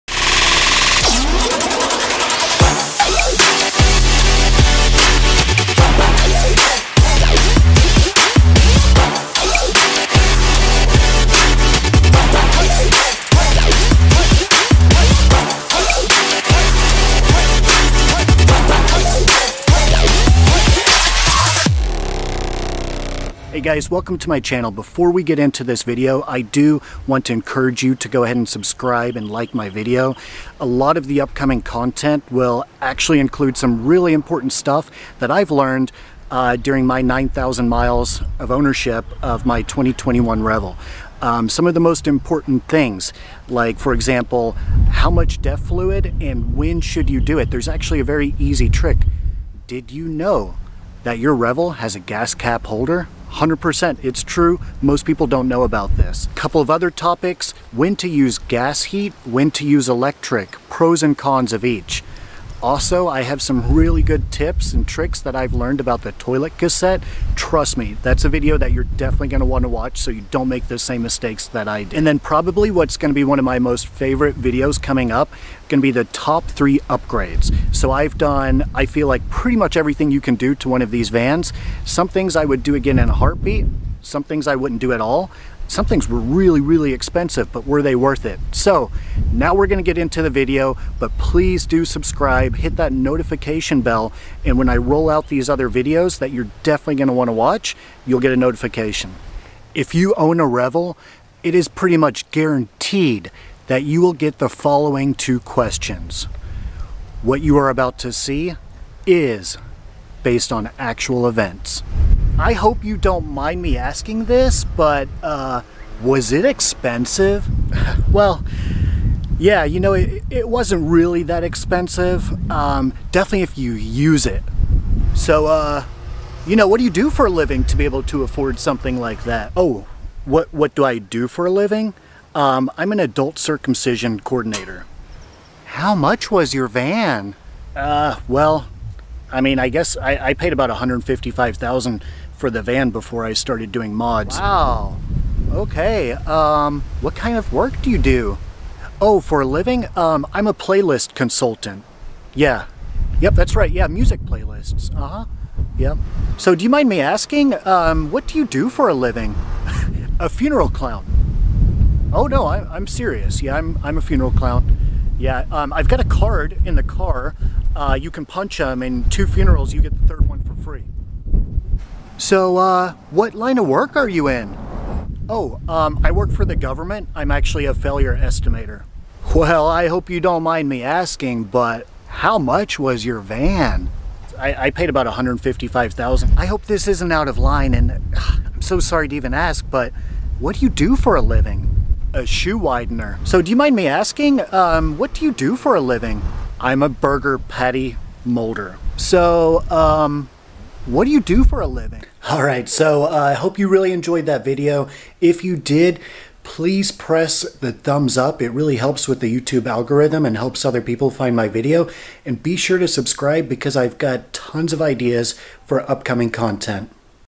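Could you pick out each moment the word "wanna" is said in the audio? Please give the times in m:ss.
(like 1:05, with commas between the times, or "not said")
1:09, 1:37.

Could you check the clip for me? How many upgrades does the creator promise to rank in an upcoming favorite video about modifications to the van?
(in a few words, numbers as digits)
3.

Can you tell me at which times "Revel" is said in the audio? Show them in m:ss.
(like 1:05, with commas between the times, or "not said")
0:40, 0:51, 1:40.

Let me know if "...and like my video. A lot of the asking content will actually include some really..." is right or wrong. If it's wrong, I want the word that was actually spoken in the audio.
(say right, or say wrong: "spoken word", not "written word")
wrong: "upcoming", not "asking".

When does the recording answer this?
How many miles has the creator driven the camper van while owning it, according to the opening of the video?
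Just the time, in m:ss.
0:37.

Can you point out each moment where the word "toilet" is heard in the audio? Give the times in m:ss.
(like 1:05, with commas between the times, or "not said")
1:06.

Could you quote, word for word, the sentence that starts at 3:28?
It really helps with the YouTube algorithm and helps other people find my video.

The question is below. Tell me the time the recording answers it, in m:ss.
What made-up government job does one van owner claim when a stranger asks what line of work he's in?
2:57.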